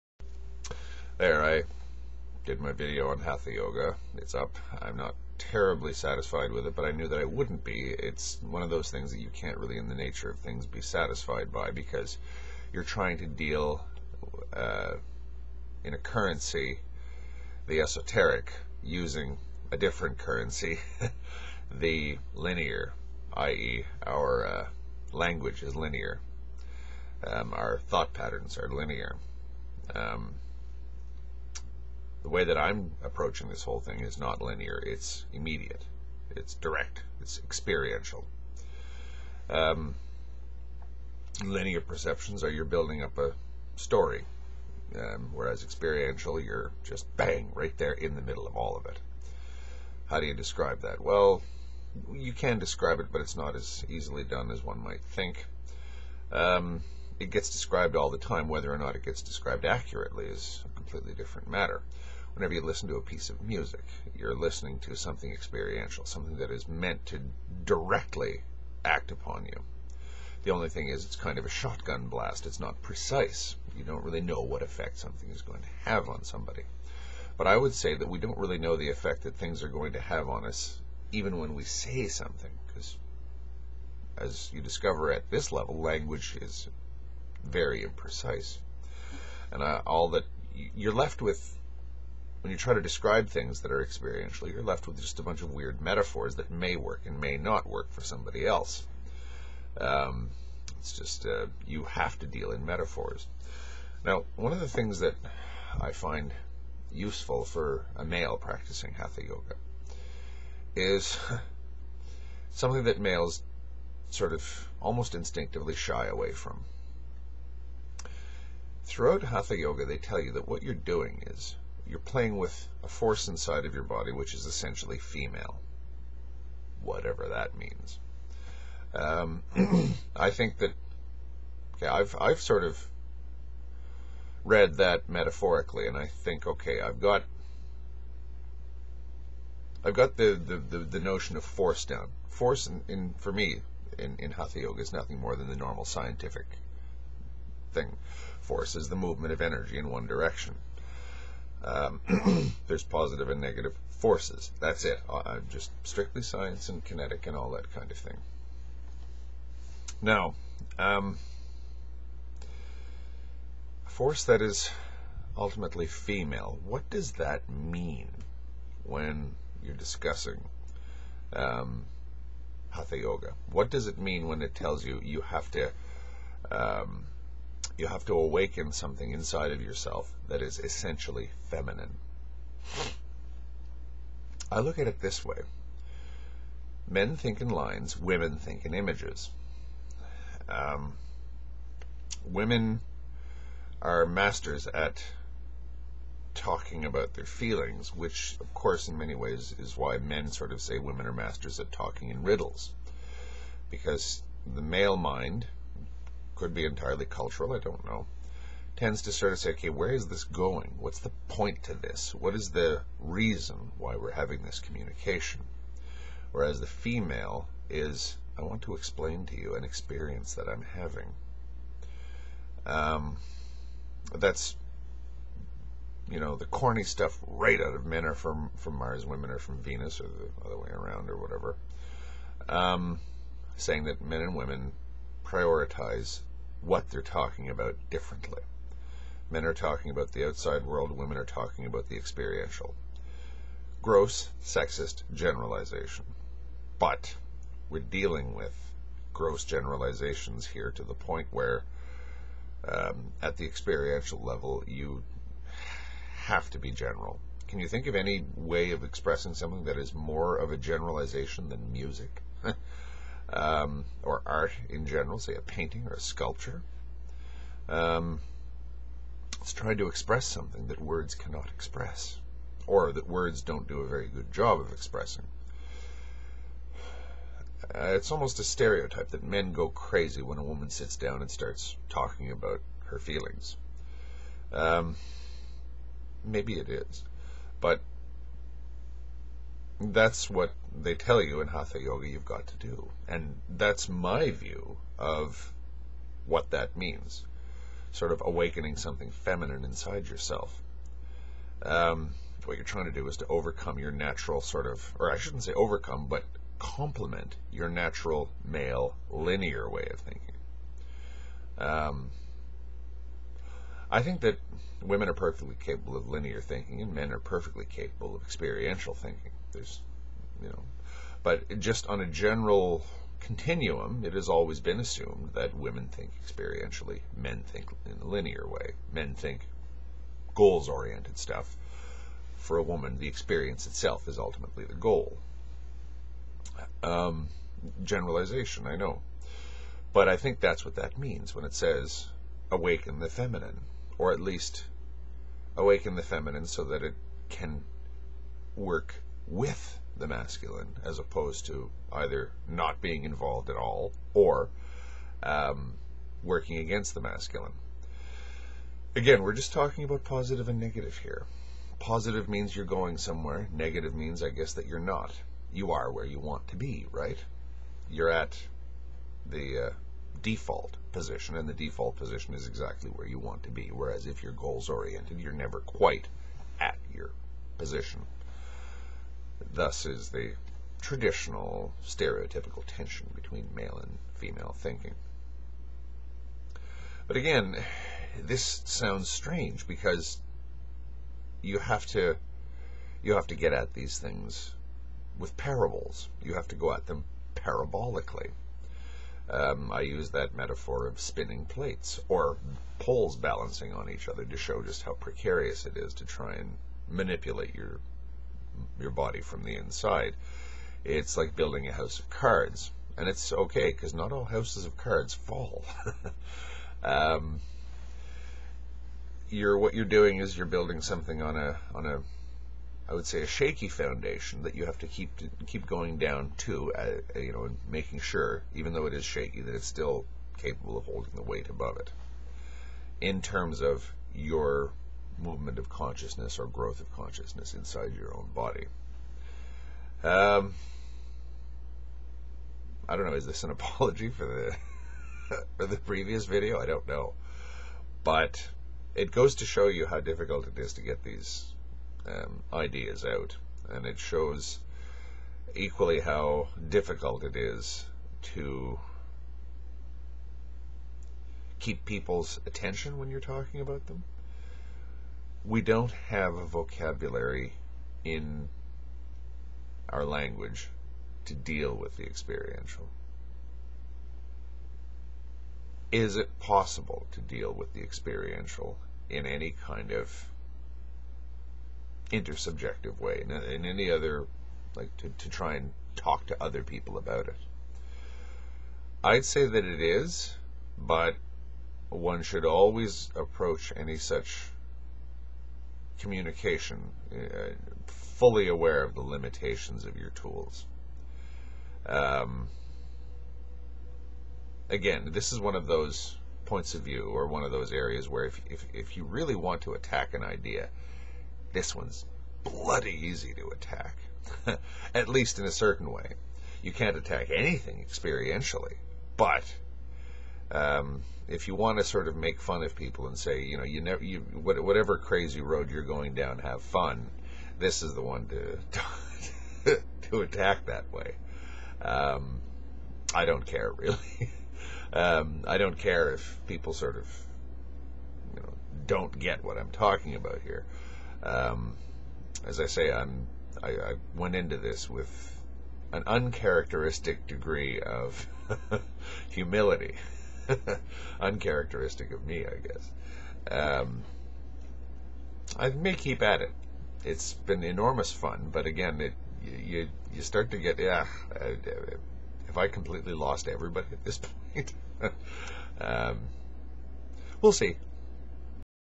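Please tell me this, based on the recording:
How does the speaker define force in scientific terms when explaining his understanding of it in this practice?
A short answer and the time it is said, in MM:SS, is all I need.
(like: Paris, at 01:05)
movement of energy in one direction, at 02:28.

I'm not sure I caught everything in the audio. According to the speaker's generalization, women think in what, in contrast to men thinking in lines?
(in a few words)
images.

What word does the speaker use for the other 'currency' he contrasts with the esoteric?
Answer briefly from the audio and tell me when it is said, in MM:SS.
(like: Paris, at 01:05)
the linear, at 00:21.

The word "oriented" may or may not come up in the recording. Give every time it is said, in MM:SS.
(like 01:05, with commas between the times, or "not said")
05:30, 06:14.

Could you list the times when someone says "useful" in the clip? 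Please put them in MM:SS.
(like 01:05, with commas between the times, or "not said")
01:46.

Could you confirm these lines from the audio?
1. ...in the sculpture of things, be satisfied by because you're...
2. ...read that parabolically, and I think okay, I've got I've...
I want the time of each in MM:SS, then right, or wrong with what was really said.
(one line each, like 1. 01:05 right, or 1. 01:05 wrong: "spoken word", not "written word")
1. 00:09 wrong: "nature", not "sculpture"
2. 02:14 wrong: "metaphorically", not "parabolically".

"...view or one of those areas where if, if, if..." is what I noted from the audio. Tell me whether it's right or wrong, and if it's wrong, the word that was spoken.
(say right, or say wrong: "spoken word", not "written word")
right.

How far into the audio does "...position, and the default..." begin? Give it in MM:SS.
06:10.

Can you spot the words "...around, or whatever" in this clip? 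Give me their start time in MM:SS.
03:50.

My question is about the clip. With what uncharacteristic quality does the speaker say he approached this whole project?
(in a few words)
humility.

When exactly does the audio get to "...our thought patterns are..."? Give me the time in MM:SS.
00:27.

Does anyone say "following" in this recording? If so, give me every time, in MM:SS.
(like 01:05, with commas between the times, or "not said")
not said.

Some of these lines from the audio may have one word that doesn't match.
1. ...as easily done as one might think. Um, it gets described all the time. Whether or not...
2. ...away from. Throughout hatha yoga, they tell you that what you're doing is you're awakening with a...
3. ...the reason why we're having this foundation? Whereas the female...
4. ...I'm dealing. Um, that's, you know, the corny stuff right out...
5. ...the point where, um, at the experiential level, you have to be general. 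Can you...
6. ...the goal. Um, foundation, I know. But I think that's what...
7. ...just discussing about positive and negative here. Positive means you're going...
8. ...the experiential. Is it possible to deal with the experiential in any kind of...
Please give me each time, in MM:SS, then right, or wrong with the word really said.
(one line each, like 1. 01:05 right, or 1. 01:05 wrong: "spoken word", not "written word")
1. 00:53 right
2. 01:56 wrong: "playing", not "awakening"
3. 03:32 wrong: "communication", not "foundation"
4. 03:40 wrong: "having", not "dealing"
5. 04:10 right
6. 05:34 wrong: "generalization", not "foundation"
7. 05:59 wrong: "talking", not "discussing"
8. 07:51 right.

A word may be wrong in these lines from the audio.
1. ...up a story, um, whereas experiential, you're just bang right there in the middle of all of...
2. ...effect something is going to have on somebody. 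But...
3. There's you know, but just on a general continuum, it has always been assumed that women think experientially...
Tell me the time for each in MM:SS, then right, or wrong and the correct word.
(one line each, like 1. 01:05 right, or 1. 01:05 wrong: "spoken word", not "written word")
1. 00:43 right
2. 01:14 right
3. 05:19 right.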